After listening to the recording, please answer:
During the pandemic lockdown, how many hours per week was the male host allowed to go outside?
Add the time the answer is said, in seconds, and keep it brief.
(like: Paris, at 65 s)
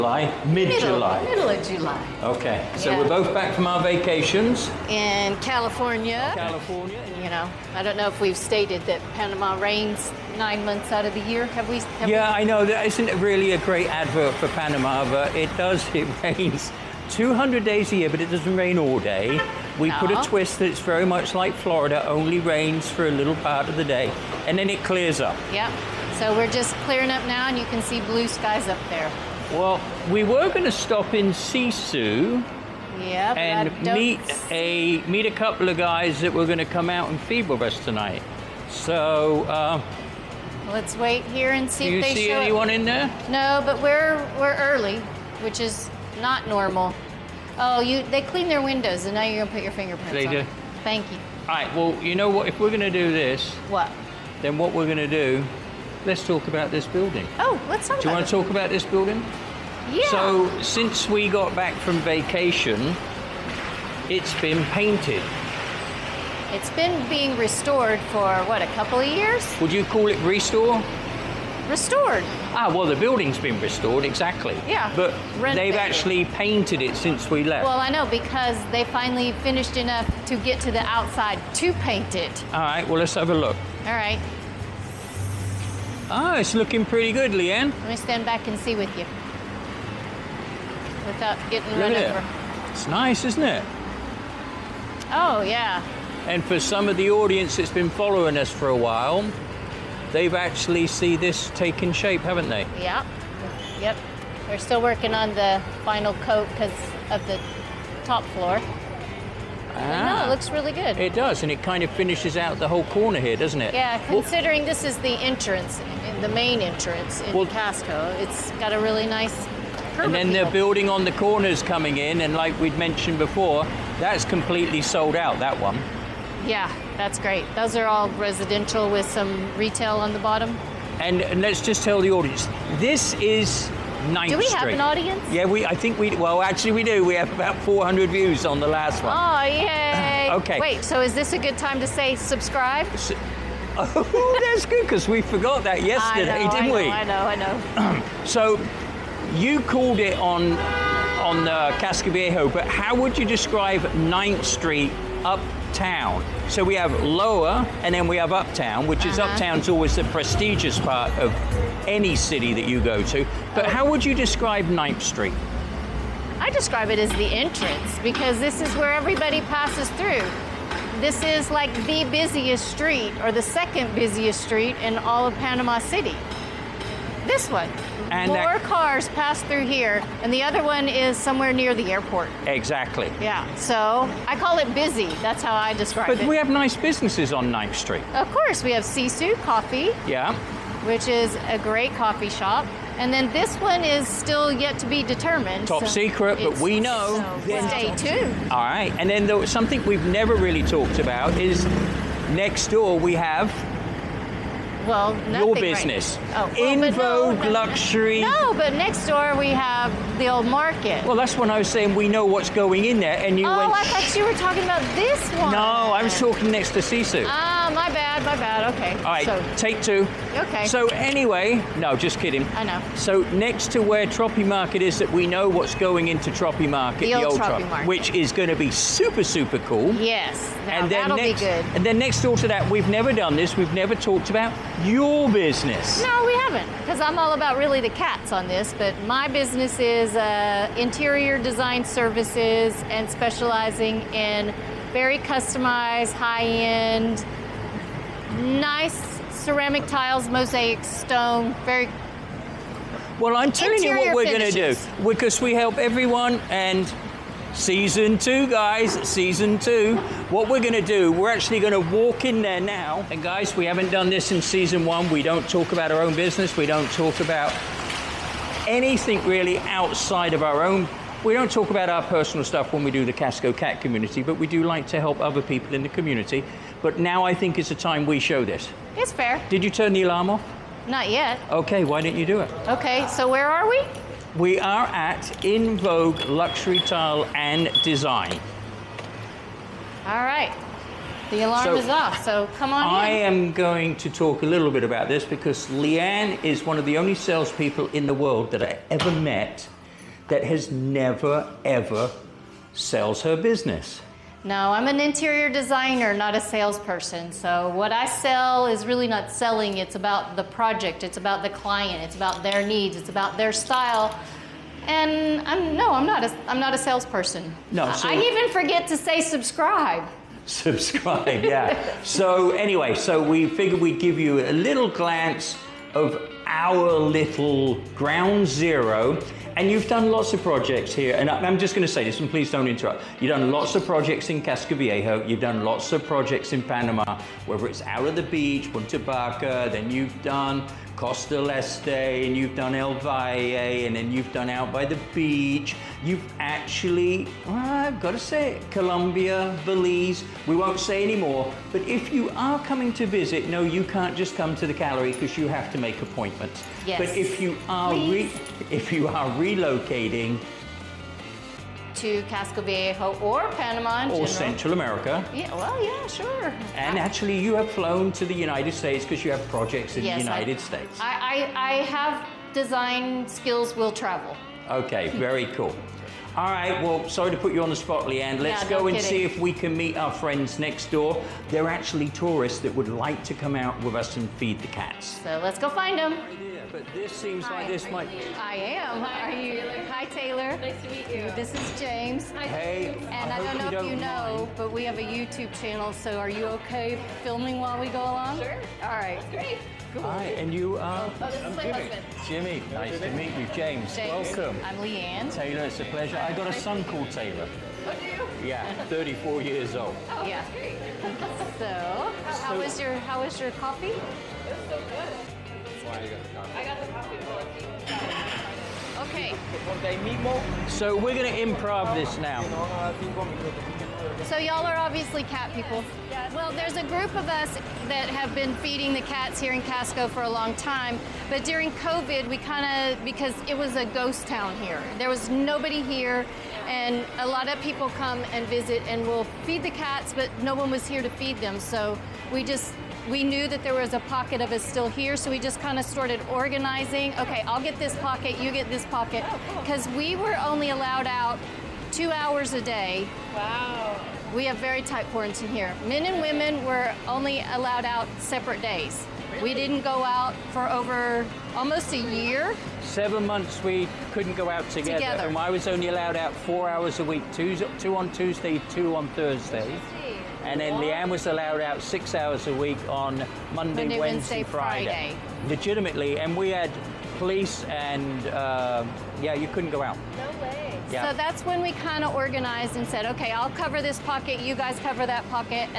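4, at 466 s.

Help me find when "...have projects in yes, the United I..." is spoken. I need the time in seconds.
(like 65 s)
369 s.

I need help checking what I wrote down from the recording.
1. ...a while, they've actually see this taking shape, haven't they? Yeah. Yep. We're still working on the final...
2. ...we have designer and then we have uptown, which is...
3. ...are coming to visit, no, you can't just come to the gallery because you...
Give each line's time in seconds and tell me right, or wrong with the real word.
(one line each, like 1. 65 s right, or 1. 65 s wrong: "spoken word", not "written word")
1. 98 s right
2. 156 s wrong: "lower", not "designer"
3. 352 s right.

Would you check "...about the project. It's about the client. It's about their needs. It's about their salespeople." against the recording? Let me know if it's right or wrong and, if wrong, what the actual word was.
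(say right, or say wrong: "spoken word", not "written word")
wrong: "style", not "salespeople".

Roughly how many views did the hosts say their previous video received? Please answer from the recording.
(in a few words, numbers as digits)
400.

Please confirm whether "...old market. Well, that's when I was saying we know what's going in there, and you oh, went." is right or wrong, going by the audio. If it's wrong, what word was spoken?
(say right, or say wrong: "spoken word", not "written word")
right.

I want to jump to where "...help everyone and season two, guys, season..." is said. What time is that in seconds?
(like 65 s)
255 s.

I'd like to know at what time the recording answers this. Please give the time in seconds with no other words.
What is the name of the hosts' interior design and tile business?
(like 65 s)
285 s.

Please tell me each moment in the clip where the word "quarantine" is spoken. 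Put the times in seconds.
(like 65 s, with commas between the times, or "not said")
455 s.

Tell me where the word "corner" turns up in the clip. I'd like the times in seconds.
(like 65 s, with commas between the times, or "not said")
112 s, 121 s.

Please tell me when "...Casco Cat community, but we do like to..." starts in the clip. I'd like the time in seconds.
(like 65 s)
273 s.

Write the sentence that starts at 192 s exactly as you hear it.
And then this one is still yet to be determined.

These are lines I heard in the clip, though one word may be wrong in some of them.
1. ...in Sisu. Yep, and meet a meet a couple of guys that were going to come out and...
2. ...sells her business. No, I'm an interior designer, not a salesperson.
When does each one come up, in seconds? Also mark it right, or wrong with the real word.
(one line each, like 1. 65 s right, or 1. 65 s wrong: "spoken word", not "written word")
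1. 31 s right
2. 302 s right.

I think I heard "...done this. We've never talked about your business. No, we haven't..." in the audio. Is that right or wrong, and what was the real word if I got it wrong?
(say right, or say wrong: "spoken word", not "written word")
right.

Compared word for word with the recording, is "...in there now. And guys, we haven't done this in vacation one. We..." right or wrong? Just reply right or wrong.
wrong.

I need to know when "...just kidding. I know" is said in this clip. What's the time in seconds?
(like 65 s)
221 s.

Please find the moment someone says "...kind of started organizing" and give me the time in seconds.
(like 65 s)
445 s.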